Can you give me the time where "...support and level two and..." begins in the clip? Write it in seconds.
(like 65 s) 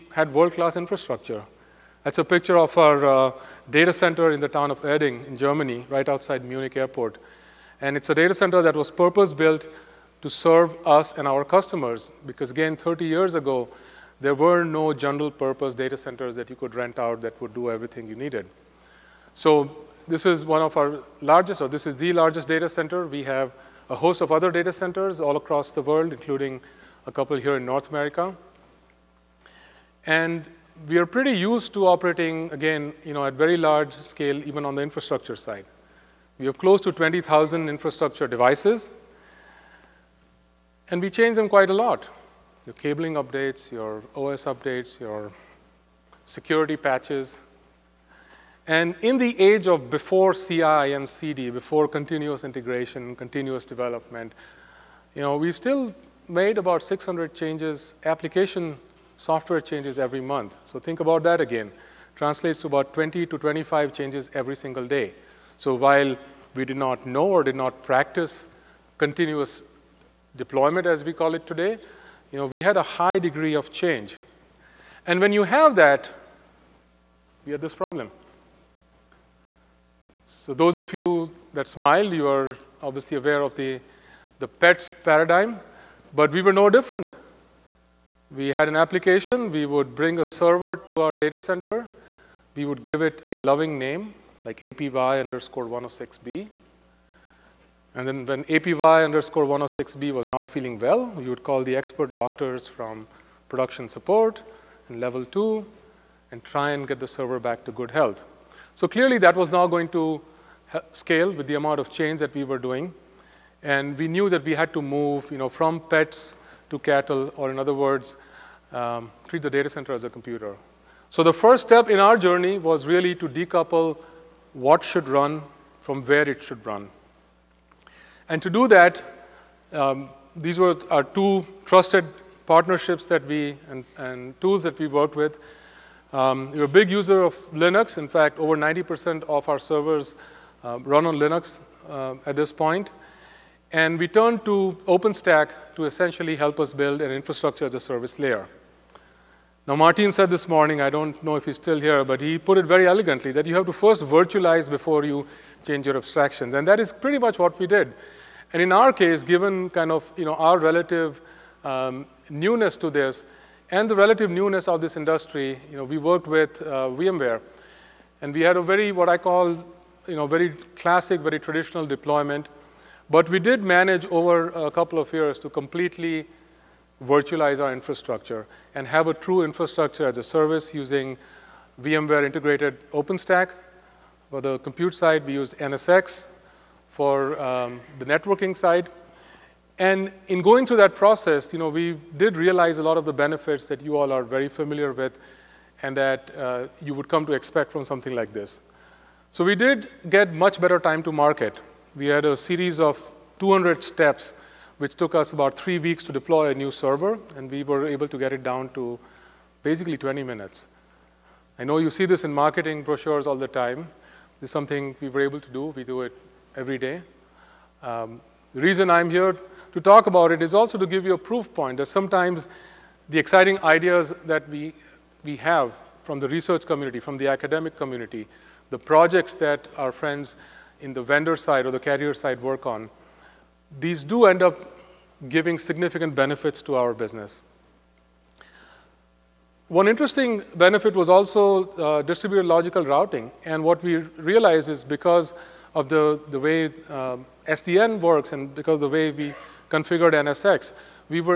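103 s.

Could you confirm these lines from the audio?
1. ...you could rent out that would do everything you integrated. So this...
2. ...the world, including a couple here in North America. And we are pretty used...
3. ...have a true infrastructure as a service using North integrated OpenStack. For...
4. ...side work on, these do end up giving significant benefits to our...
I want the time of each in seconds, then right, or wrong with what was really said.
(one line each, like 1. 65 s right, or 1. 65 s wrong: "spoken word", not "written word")
1. 16 s wrong: "needed", not "integrated"
2. 25 s right
3. 178 s wrong: "VMware", not "North"
4. 232 s right.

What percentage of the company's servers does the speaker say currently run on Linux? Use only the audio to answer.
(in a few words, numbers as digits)
over 90%.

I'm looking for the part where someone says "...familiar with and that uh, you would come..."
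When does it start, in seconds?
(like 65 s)
194 s.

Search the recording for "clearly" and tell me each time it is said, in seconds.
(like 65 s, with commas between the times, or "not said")
108 s.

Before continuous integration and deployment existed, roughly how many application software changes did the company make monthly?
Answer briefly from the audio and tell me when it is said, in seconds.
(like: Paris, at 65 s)
600, at 56 s.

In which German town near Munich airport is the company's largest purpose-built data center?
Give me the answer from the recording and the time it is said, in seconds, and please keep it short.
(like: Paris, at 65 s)
Erding, at 4 s.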